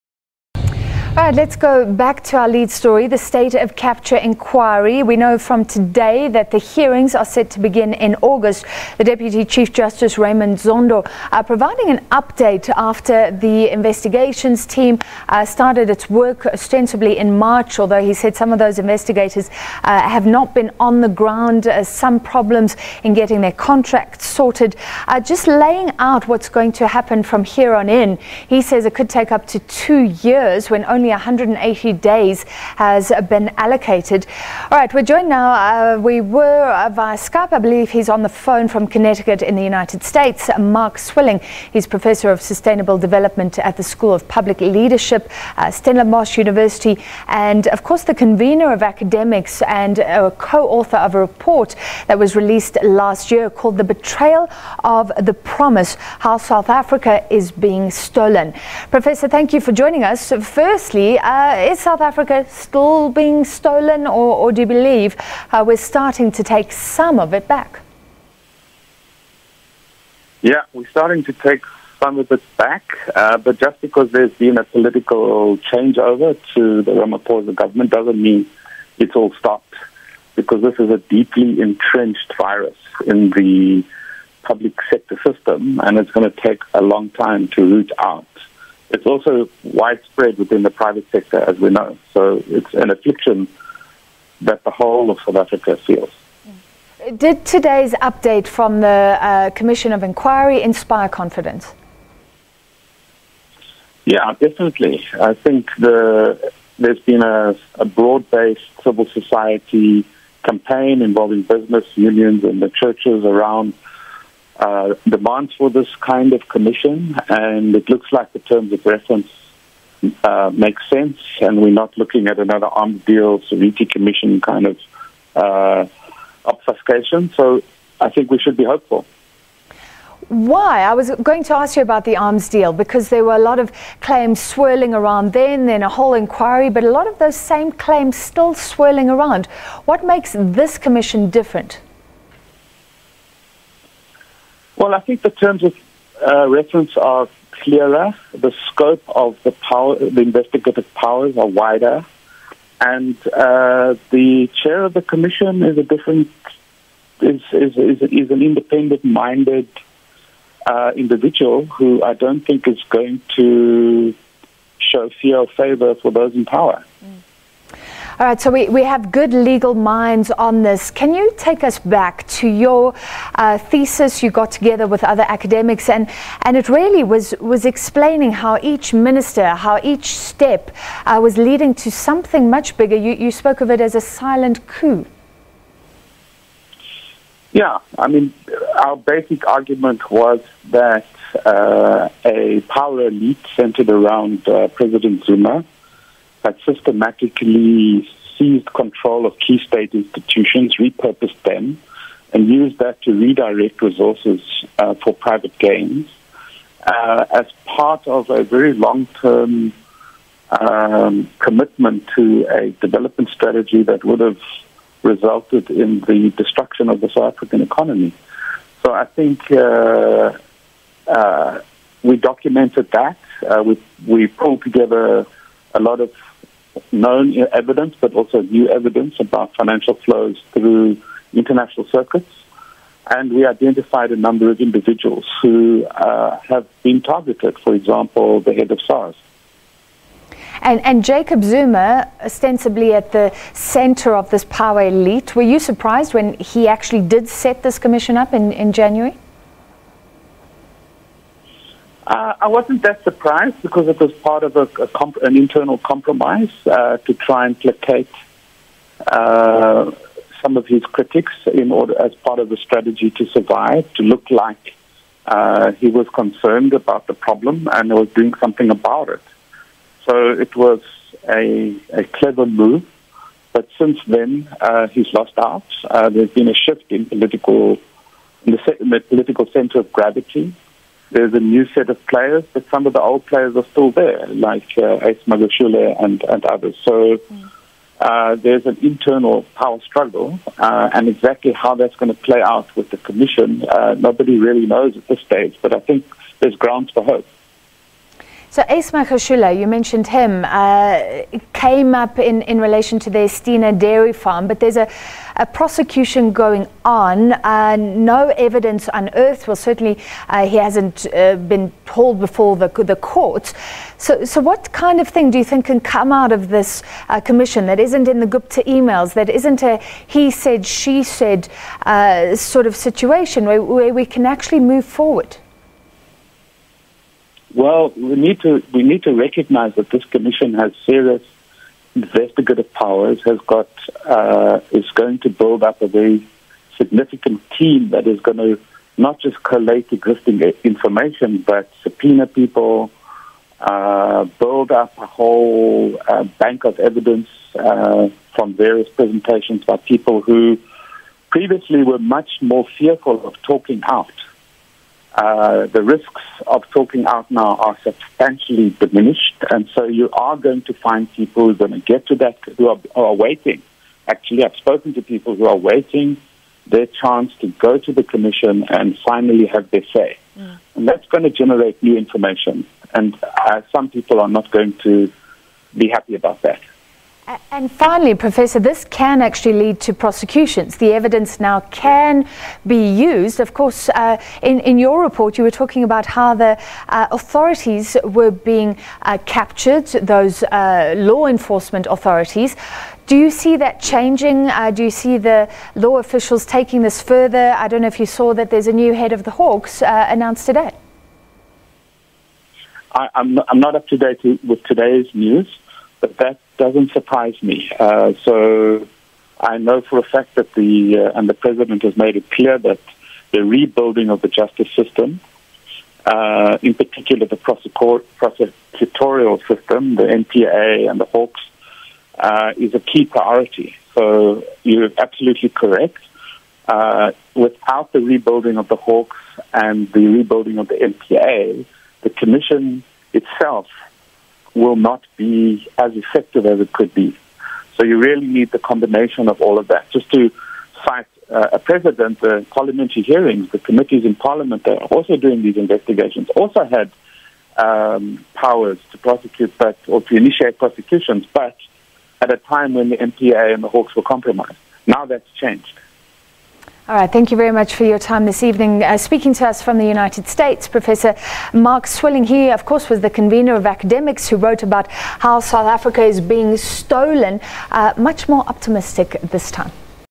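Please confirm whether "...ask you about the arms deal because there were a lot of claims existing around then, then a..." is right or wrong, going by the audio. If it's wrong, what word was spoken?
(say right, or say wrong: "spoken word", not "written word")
wrong: "swirling", not "existing".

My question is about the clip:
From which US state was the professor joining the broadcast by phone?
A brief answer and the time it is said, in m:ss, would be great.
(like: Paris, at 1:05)
Connecticut, at 0:38.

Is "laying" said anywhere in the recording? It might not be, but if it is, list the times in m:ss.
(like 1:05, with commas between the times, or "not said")
0:25.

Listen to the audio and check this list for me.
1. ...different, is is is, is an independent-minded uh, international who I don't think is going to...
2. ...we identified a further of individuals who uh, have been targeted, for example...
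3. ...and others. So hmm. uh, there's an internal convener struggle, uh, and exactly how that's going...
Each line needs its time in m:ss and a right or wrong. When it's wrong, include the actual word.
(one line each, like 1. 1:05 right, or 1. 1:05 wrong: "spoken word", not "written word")
1. 2:35 wrong: "individual", not "international"
2. 3:53 wrong: "number", not "further"
3. 4:46 wrong: "power", not "convener".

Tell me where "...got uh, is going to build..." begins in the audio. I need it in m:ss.
5:33.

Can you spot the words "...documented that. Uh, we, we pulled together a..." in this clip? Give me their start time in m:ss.
3:42.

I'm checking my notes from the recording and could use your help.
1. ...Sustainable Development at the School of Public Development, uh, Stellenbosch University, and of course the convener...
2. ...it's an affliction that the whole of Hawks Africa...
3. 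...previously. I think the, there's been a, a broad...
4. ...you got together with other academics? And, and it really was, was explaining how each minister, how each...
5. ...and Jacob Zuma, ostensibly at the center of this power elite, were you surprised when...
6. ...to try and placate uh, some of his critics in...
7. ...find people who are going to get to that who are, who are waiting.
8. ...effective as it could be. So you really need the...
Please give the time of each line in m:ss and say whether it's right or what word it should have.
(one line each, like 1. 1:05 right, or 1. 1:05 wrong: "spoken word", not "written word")
1. 0:42 wrong: "Leadership", not "Development"
2. 1:32 wrong: "South", not "Hawks"
3. 1:44 wrong: "definitely", not "previously"
4. 2:54 right
5. 4:00 right
6. 4:16 right
7. 6:00 right
8. 7:15 right.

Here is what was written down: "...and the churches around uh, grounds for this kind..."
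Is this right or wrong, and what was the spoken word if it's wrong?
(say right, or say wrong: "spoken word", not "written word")
wrong: "demands", not "grounds".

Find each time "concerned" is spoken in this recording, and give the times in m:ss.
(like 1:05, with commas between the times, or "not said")
4:26.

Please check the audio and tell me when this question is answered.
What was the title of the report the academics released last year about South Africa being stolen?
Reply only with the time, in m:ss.
0:53.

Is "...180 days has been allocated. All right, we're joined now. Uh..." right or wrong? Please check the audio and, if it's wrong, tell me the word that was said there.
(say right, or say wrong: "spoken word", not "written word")
right.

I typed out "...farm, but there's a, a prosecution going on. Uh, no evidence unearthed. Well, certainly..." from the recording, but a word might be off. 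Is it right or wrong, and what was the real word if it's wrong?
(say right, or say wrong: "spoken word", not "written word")
right.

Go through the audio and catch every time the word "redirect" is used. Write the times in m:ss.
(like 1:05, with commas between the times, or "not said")
3:23.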